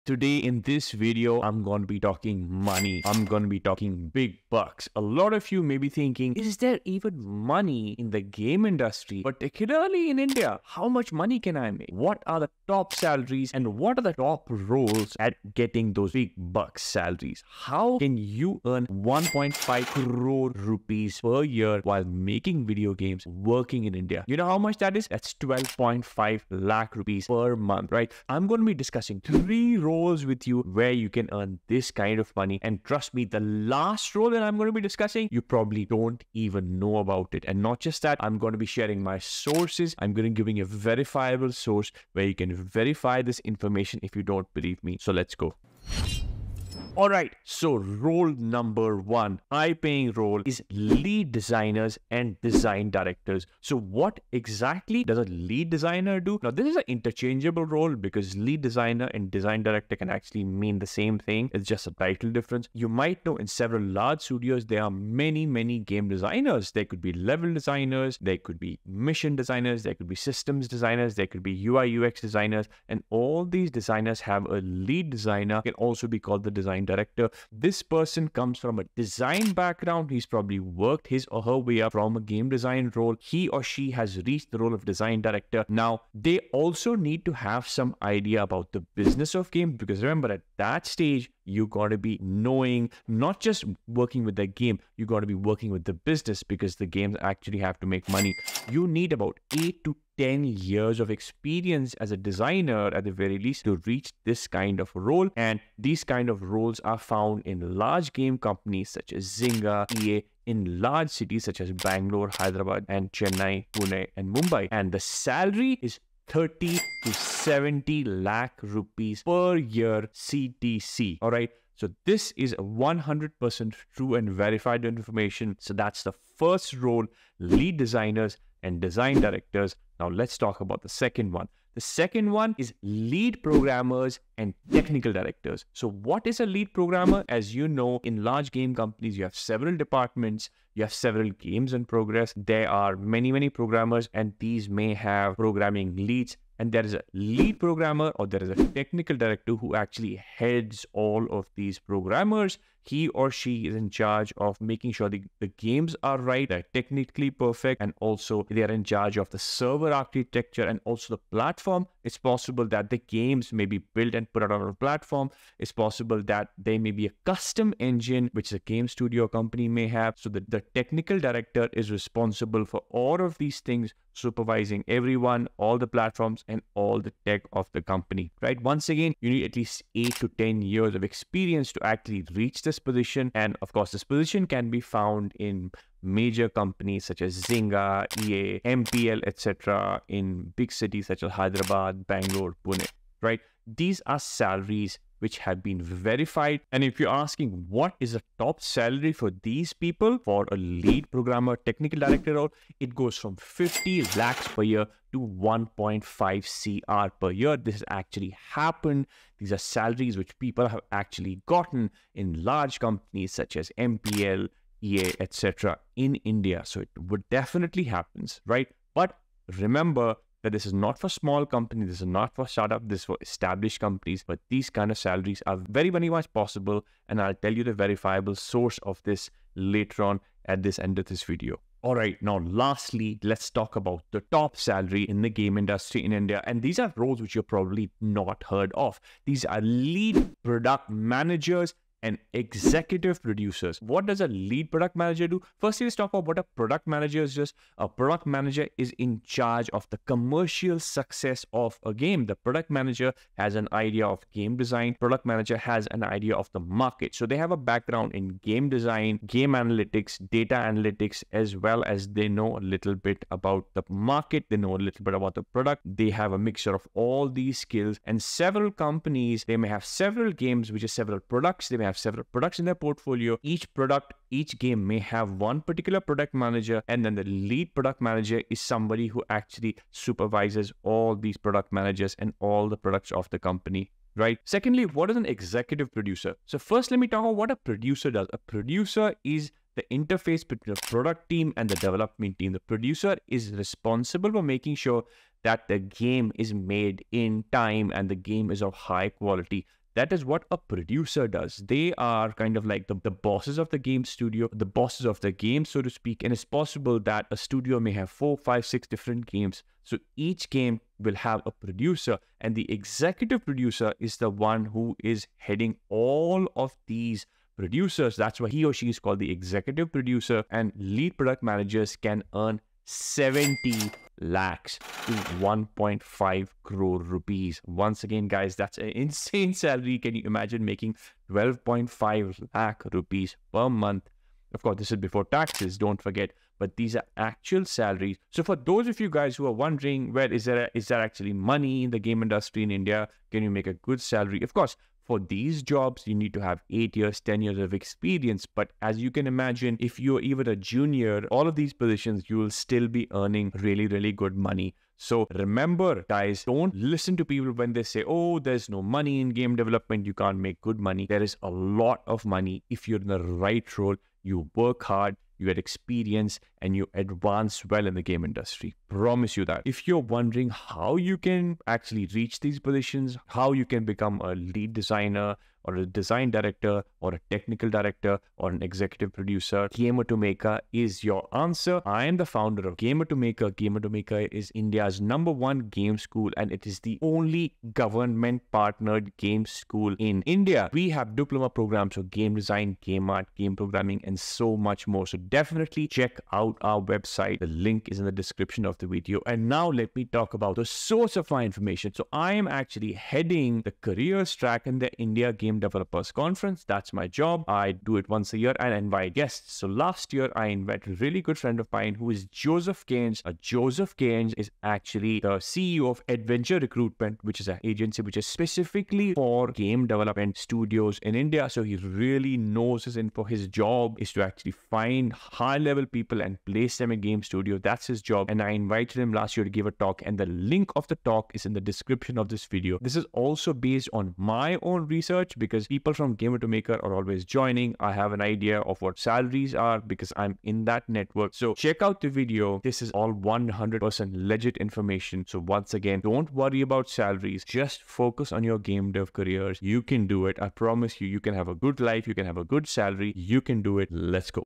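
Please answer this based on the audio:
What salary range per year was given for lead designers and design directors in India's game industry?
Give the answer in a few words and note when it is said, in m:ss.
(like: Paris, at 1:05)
30 to 70 lakh rupees, at 1:56.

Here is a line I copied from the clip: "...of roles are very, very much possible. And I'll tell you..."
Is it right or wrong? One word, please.
wrong.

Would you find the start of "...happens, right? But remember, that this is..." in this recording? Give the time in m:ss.
3:37.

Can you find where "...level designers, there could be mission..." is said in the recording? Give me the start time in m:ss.
1:07.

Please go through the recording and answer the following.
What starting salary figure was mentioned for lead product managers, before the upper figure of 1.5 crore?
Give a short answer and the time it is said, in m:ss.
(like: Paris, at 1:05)
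70 lakhs, at 5:22.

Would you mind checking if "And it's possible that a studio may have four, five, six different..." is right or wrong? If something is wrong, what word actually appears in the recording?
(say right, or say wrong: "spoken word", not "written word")
right.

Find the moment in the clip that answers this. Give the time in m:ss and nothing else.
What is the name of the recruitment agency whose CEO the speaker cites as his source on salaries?
6:56.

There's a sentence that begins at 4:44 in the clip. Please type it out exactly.
Secondly, what is an executive producer?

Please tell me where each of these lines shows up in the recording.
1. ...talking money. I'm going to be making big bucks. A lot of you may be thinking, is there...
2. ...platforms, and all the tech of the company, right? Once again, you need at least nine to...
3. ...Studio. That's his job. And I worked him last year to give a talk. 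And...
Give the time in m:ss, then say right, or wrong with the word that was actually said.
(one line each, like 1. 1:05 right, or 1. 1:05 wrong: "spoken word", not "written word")
1. 0:01 wrong: "talking", not "making"
2. 2:55 wrong: "eight", not "nine"
3. 7:07 wrong: "invited", not "worked".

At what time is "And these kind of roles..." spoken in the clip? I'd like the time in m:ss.
1:45.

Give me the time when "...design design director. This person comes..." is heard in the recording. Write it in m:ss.
1:16.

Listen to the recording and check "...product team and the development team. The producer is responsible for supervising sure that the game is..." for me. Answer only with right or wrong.
wrong.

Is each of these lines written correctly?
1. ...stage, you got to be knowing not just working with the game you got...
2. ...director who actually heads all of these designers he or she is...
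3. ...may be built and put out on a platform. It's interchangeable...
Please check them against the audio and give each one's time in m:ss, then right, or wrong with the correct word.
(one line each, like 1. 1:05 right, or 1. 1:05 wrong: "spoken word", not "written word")
1. 1:30 right
2. 2:29 wrong: "programmers", not "designers"
3. 2:43 wrong: "possible", not "interchangeable".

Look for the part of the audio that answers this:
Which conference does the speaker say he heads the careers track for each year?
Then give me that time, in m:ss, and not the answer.
6:44.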